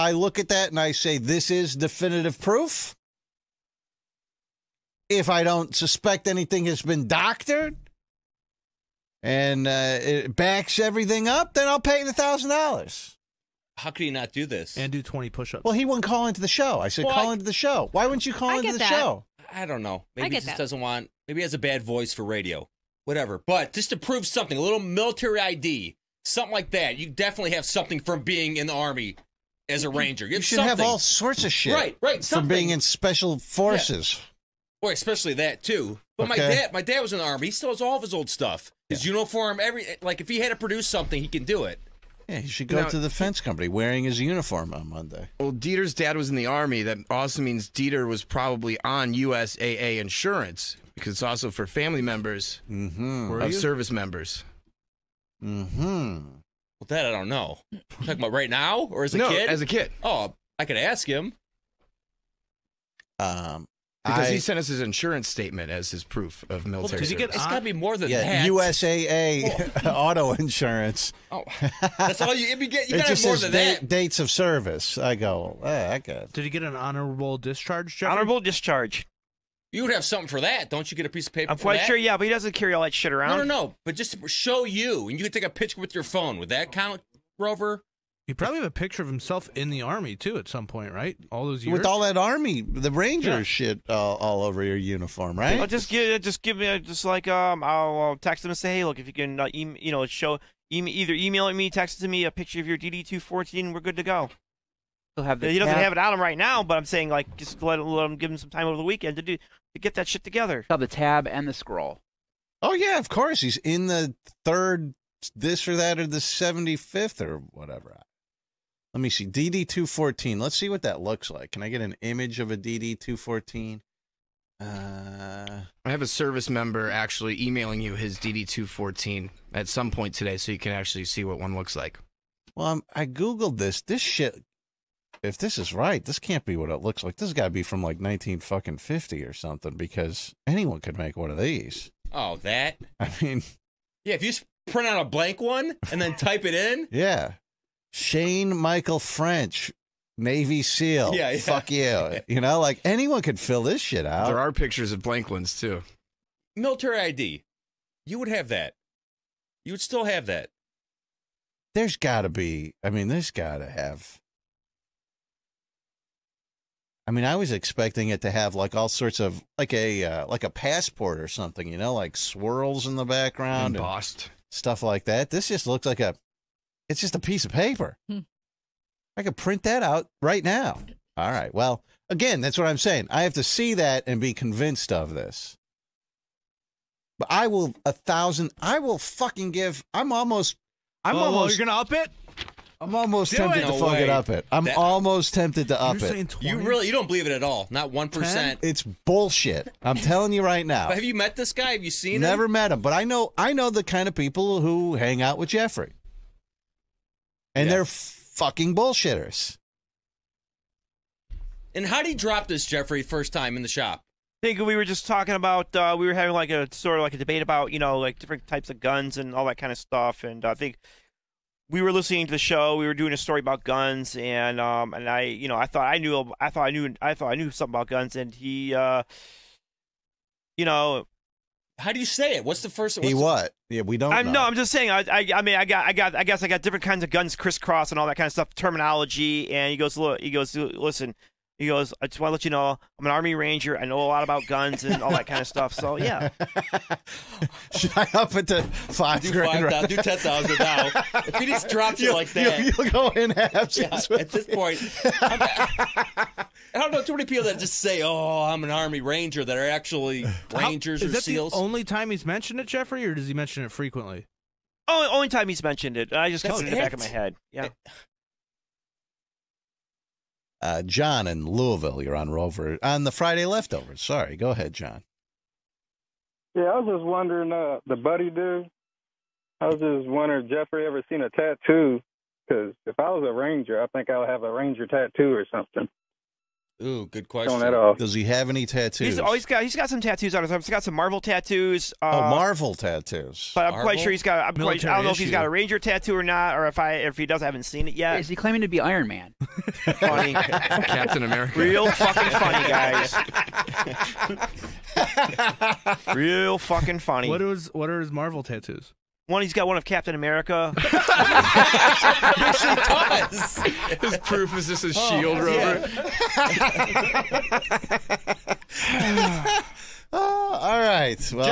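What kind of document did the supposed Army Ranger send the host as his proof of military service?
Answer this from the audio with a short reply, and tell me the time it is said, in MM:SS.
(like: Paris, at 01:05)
Insurance statement, at 01:04.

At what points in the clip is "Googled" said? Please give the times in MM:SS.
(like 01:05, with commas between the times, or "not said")
02:13.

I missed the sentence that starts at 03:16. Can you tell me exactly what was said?
You really you don't believe it at all.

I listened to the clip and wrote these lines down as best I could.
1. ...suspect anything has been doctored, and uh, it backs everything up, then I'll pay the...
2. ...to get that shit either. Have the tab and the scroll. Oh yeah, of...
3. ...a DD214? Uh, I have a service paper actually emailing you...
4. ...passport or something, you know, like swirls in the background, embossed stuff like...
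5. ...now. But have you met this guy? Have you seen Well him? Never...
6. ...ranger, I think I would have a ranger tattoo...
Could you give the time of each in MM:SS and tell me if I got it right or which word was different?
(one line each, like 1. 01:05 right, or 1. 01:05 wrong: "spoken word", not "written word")
1. 00:05 right
2. 01:49 wrong: "together", not "either"
3. 02:02 wrong: "member", not "paper"
4. 02:50 right
5. 03:20 wrong: "Never", not "Well"
6. 04:43 right.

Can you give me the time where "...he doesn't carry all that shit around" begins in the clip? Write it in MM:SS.
01:22.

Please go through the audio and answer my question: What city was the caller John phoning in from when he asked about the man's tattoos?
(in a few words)
Louisville.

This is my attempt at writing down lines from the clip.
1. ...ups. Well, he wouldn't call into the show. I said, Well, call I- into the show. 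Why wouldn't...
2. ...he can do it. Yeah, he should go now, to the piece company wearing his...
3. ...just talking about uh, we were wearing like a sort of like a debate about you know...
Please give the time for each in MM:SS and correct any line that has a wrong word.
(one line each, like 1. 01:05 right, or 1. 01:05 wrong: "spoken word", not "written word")
1. 00:15 right
2. 00:41 wrong: "fence", not "piece"
3. 03:34 wrong: "having", not "wearing".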